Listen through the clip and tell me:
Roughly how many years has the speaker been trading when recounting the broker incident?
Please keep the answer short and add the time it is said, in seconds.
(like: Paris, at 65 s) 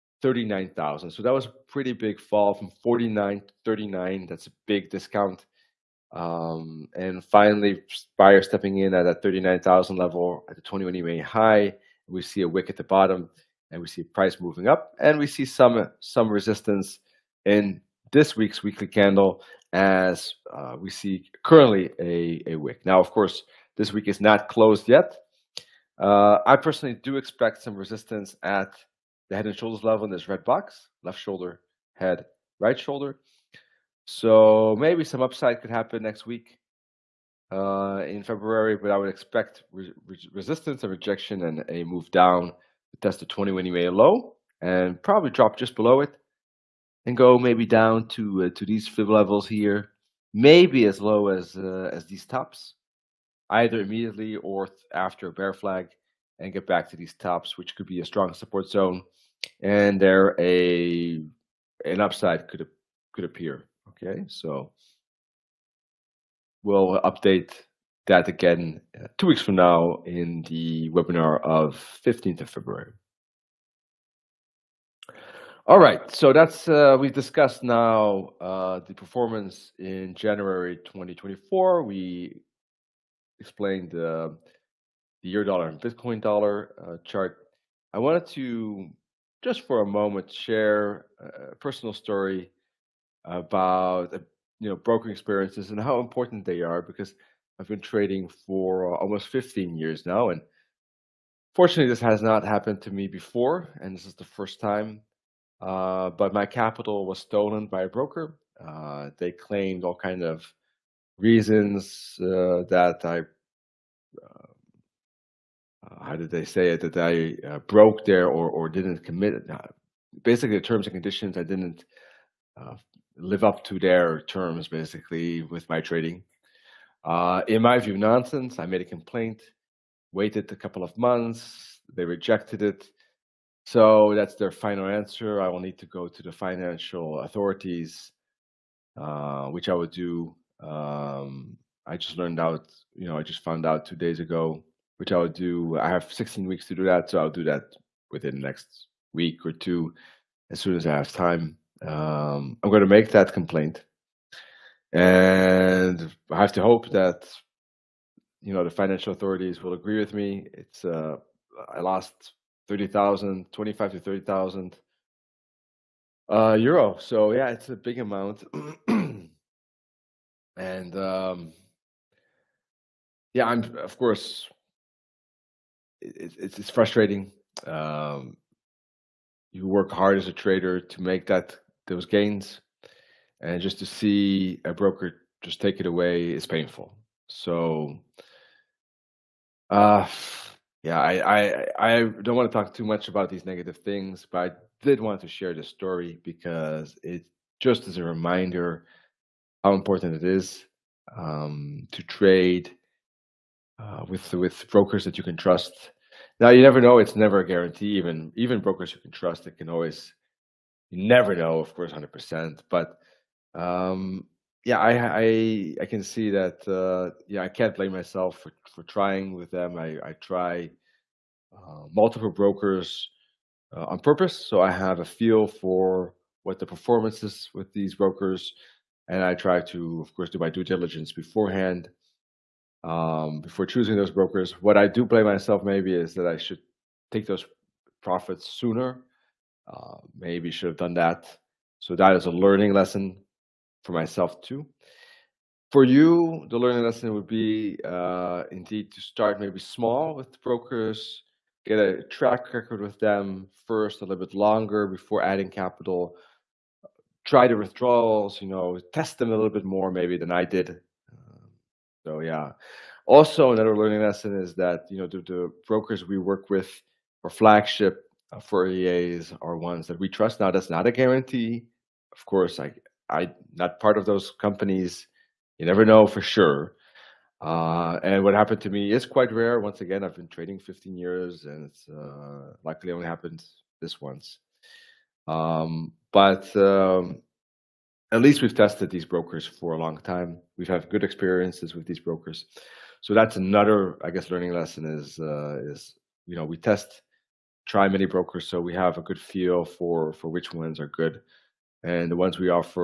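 15 years, at 98 s.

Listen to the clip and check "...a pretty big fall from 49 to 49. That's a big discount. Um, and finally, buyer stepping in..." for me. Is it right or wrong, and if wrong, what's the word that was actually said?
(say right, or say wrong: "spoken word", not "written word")
wrong: "39", not "49".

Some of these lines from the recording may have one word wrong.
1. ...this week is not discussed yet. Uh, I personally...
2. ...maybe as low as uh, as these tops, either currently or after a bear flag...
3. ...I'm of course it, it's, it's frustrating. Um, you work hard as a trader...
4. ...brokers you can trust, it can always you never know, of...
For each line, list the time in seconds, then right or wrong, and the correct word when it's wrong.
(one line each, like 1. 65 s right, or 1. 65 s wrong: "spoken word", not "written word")
1. 23 s wrong: "closed", not "discussed"
2. 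50 s wrong: "immediately", not "currently"
3. 173 s right
4. 208 s right.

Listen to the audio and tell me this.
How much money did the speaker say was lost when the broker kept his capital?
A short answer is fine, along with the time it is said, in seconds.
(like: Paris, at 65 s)
30,000 euro, at 163 s.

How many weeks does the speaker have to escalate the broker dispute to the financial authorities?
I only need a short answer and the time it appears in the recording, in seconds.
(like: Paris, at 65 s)
16 weeks, at 146 s.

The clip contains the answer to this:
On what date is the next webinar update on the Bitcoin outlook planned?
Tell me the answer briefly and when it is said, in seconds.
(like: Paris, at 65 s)
15th of February, at 72 s.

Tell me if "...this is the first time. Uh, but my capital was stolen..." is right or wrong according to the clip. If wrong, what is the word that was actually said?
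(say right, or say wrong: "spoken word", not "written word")
right.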